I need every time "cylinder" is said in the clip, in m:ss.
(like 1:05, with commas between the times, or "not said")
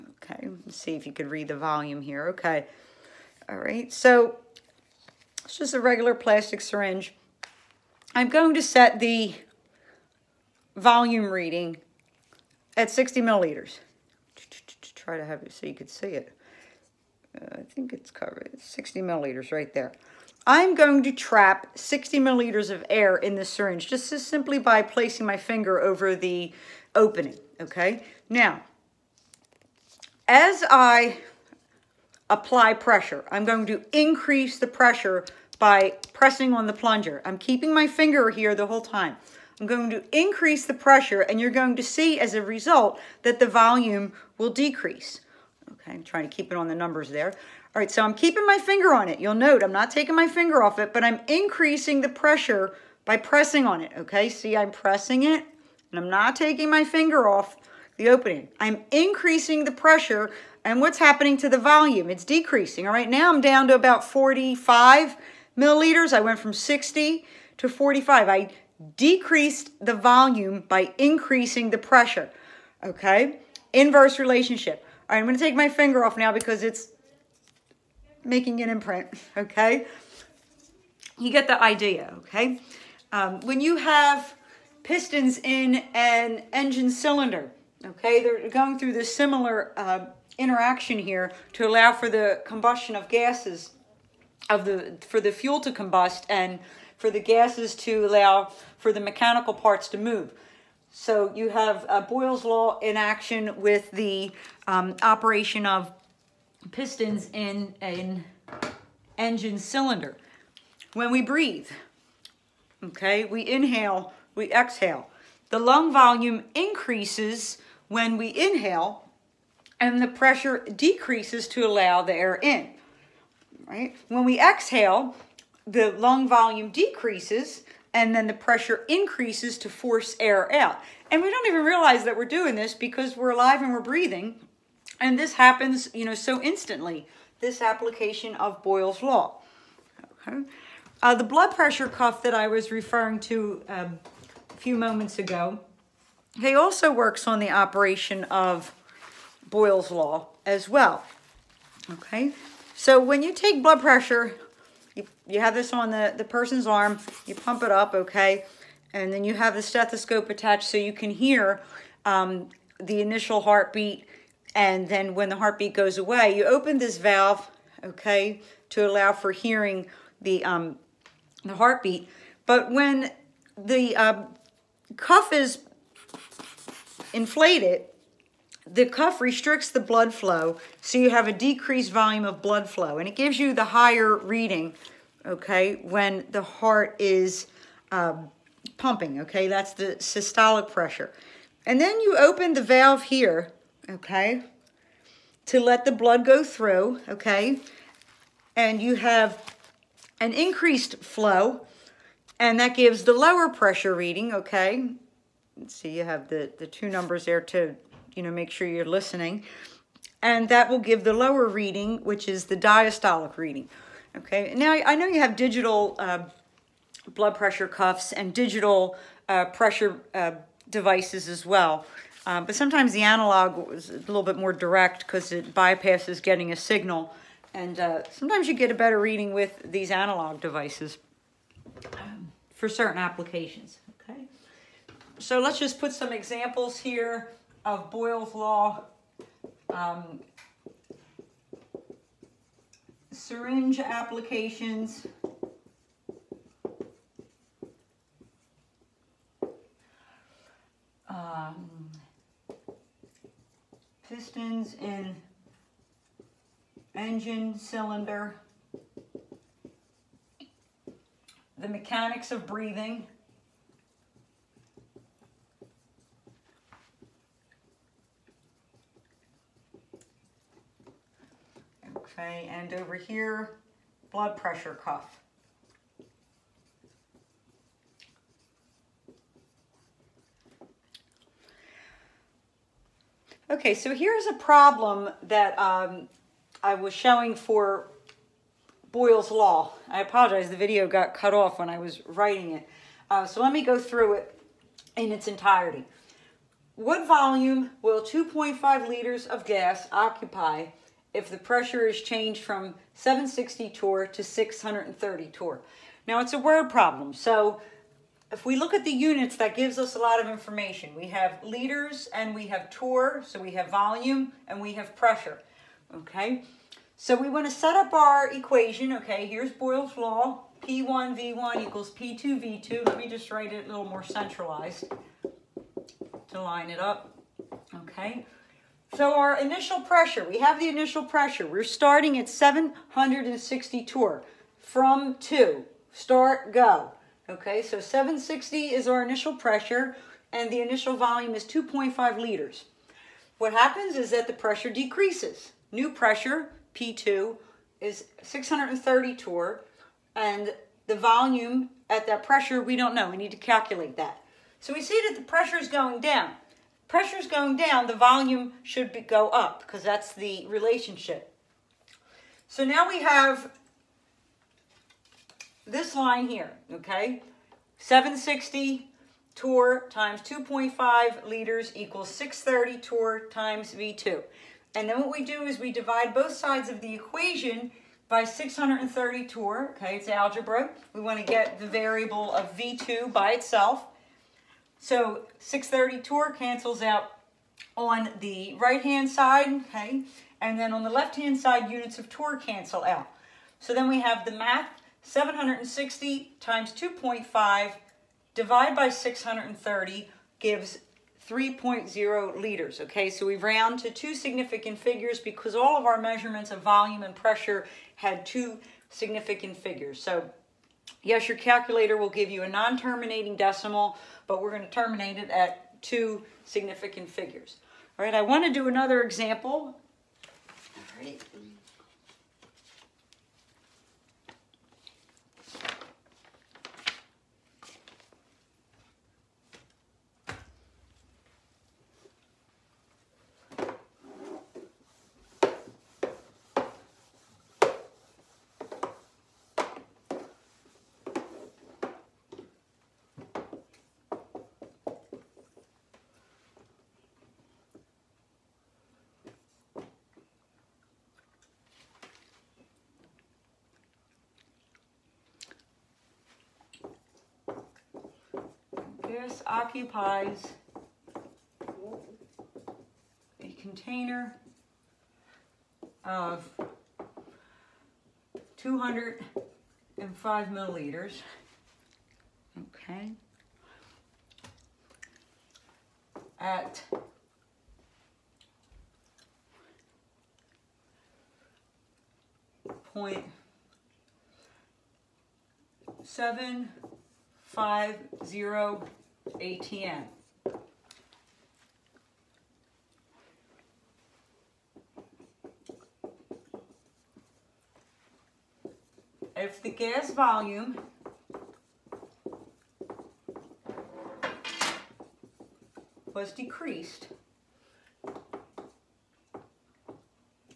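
1:26, 1:49, 4:17.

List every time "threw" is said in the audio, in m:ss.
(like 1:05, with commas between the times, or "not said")
not said.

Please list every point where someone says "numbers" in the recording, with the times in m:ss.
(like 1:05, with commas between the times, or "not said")
0:46, 3:26.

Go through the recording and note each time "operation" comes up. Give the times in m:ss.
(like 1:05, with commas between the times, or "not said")
1:45, 2:27.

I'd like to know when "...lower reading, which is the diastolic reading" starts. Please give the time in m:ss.
3:31.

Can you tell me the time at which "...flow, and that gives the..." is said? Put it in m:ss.
3:21.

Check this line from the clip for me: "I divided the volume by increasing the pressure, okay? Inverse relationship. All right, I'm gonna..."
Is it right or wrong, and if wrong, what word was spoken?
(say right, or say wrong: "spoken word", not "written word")
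wrong: "decreased", not "divided".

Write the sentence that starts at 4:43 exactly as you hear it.
Okay, so here's a problem that um, I was showing for Boyle's Law.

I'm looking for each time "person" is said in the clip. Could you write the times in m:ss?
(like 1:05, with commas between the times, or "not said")
2:36.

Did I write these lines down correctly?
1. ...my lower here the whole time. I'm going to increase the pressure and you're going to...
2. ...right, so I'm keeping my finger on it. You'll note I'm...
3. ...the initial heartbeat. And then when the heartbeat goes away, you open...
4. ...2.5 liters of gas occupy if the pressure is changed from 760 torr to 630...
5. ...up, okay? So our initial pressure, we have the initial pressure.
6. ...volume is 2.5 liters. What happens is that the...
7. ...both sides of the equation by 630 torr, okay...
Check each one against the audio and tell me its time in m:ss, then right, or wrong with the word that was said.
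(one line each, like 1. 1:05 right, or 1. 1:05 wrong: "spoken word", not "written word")
1. 0:37 wrong: "finger", not "lower"
2. 0:47 right
3. 2:42 right
4. 4:58 right
5. 5:26 right
6. 5:40 right
7. 6:16 right.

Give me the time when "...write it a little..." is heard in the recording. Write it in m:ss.
5:23.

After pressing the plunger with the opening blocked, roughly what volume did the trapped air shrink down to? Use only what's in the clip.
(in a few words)
45 milliliters.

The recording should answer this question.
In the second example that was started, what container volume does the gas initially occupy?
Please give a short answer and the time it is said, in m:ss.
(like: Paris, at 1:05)
205 milliliters, at 7:48.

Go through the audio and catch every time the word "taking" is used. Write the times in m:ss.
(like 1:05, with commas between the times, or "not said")
0:49, 0:56.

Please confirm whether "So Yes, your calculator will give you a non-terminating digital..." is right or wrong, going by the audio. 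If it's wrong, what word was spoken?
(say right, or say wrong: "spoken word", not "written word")
wrong: "decimal", not "digital".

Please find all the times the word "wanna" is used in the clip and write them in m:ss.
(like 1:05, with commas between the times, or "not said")
5:17.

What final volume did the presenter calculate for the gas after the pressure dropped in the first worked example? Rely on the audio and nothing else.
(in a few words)
3.0 liters.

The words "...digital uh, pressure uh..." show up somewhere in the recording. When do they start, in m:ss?
3:38.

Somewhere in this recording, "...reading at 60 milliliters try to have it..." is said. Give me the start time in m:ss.
0:11.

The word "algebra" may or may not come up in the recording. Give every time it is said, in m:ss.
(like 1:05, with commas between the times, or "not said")
6:20.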